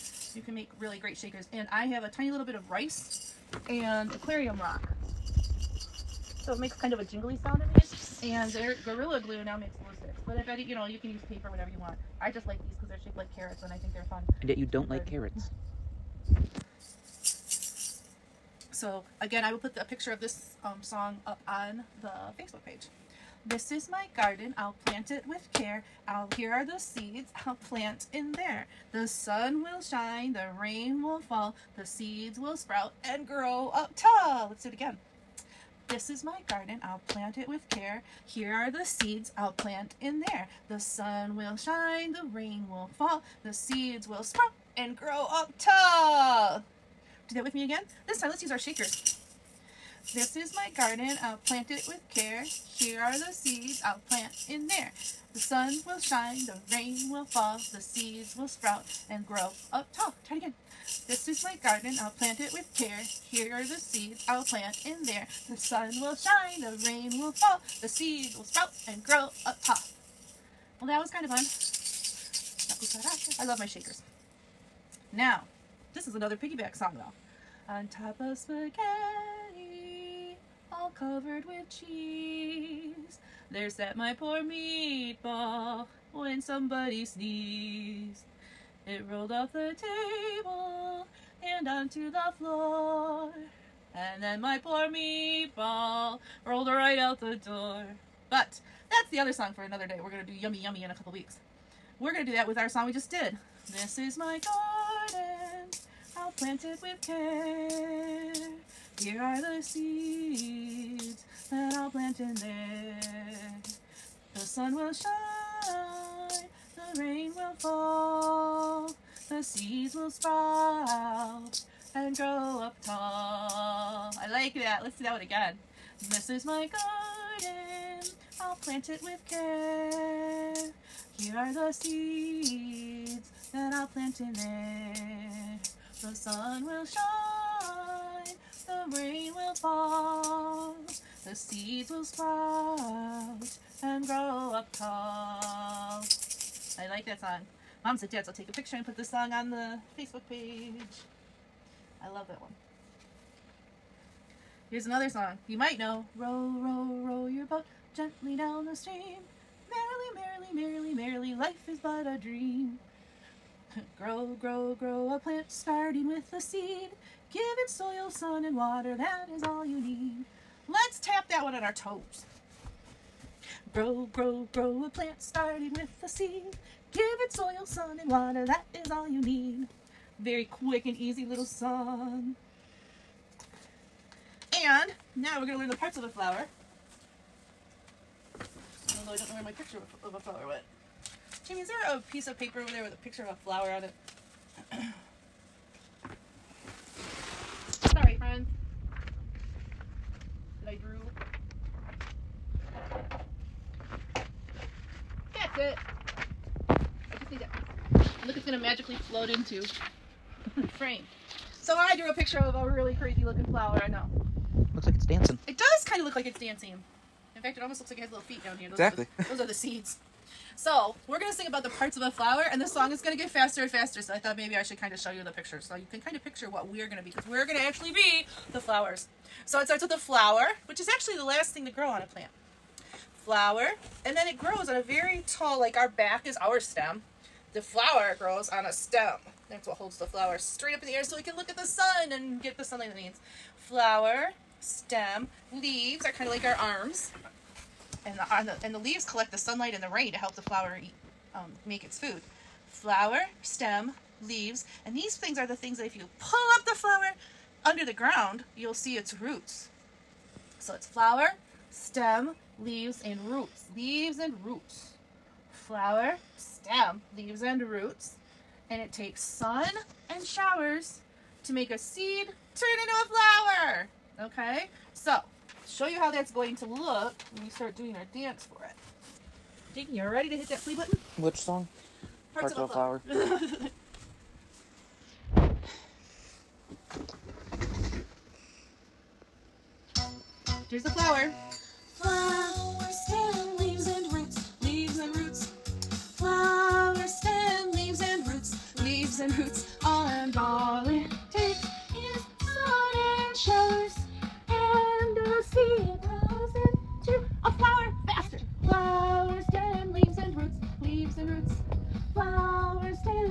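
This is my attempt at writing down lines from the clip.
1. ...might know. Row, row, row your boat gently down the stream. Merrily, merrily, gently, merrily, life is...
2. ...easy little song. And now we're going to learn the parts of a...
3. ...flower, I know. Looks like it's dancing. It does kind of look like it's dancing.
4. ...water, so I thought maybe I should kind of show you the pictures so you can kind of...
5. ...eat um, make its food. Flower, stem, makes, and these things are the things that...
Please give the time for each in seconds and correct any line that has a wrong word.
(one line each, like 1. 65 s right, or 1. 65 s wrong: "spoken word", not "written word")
1. 155 s wrong: "merrily", not "gently"
2. 180 s right
3. 213 s right
4. 223 s wrong: "faster", not "water"
5. 250 s wrong: "leaves", not "makes".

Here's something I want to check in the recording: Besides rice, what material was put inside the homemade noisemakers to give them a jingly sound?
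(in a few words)
aquarium rock.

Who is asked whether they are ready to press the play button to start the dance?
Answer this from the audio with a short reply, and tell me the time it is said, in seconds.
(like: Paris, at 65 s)
Jakey, at 279 s.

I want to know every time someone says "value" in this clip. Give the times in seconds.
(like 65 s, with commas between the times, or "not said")
not said.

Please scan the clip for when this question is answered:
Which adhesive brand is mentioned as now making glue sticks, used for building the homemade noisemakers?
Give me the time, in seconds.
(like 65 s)
8 s.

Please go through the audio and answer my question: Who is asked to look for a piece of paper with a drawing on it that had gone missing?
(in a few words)
Jamie.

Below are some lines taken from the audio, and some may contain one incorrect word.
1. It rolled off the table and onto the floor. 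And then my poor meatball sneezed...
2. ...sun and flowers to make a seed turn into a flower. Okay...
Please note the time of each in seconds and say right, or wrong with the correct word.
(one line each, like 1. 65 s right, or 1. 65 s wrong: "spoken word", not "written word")
1. 88 s wrong: "rolled", not "sneezed"
2. 269 s wrong: "showers", not "flowers".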